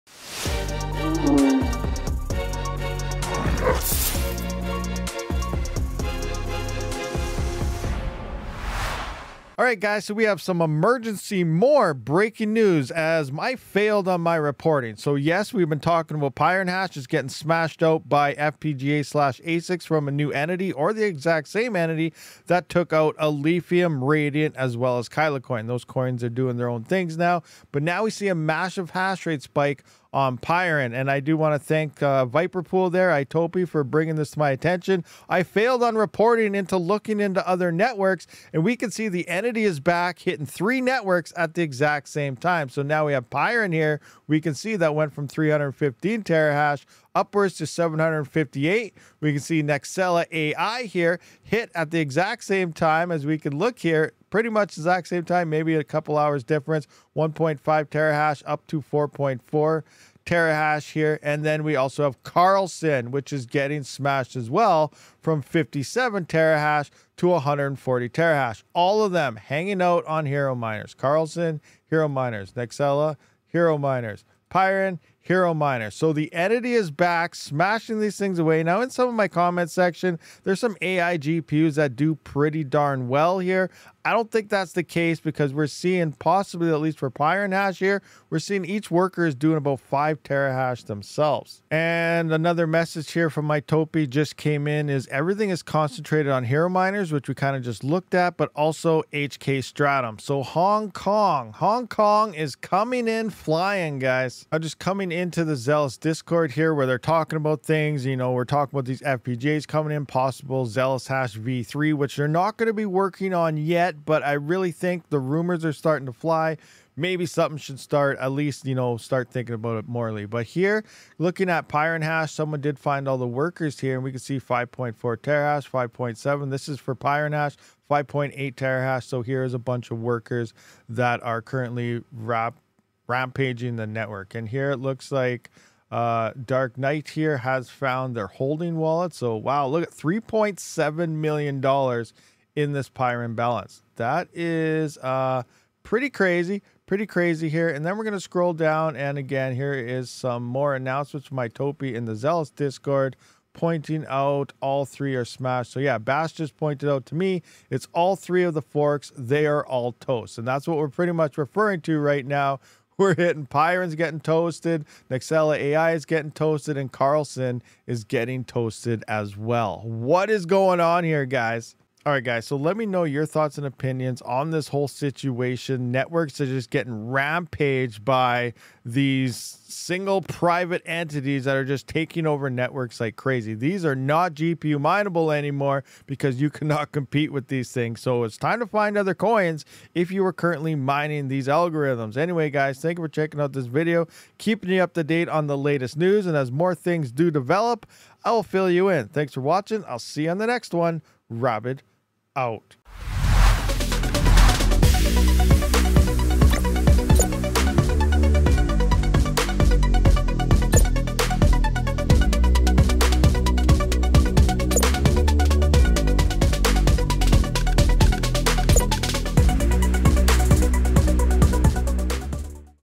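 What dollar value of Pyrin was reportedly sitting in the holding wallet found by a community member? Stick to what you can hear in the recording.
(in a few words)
$3.7 million.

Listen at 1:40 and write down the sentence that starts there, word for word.
So Hong Kong, Hong Kong is coming in flying, guys.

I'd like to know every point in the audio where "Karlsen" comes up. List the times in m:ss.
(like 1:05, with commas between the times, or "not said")
1:02, 1:10, 2:46.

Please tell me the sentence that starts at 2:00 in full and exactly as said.
But here, looking at Pyrin Hash, someone did find all the workers here, and we can see 5.4 terahash, 5.7.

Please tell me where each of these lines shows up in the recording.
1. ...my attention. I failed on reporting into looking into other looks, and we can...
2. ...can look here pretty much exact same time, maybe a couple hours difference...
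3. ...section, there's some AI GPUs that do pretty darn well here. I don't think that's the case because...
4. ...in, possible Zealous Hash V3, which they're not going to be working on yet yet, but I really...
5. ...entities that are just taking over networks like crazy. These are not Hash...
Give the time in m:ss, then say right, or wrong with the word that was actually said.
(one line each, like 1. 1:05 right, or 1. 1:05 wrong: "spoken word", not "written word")
1. 0:34 wrong: "networks", not "looks"
2. 0:53 right
3. 1:19 right
4. 1:49 right
5. 3:00 wrong: "GPU", not "Hash".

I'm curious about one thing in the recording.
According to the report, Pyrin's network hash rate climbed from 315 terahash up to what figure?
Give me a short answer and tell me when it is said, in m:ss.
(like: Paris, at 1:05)
758 terahash, at 0:47.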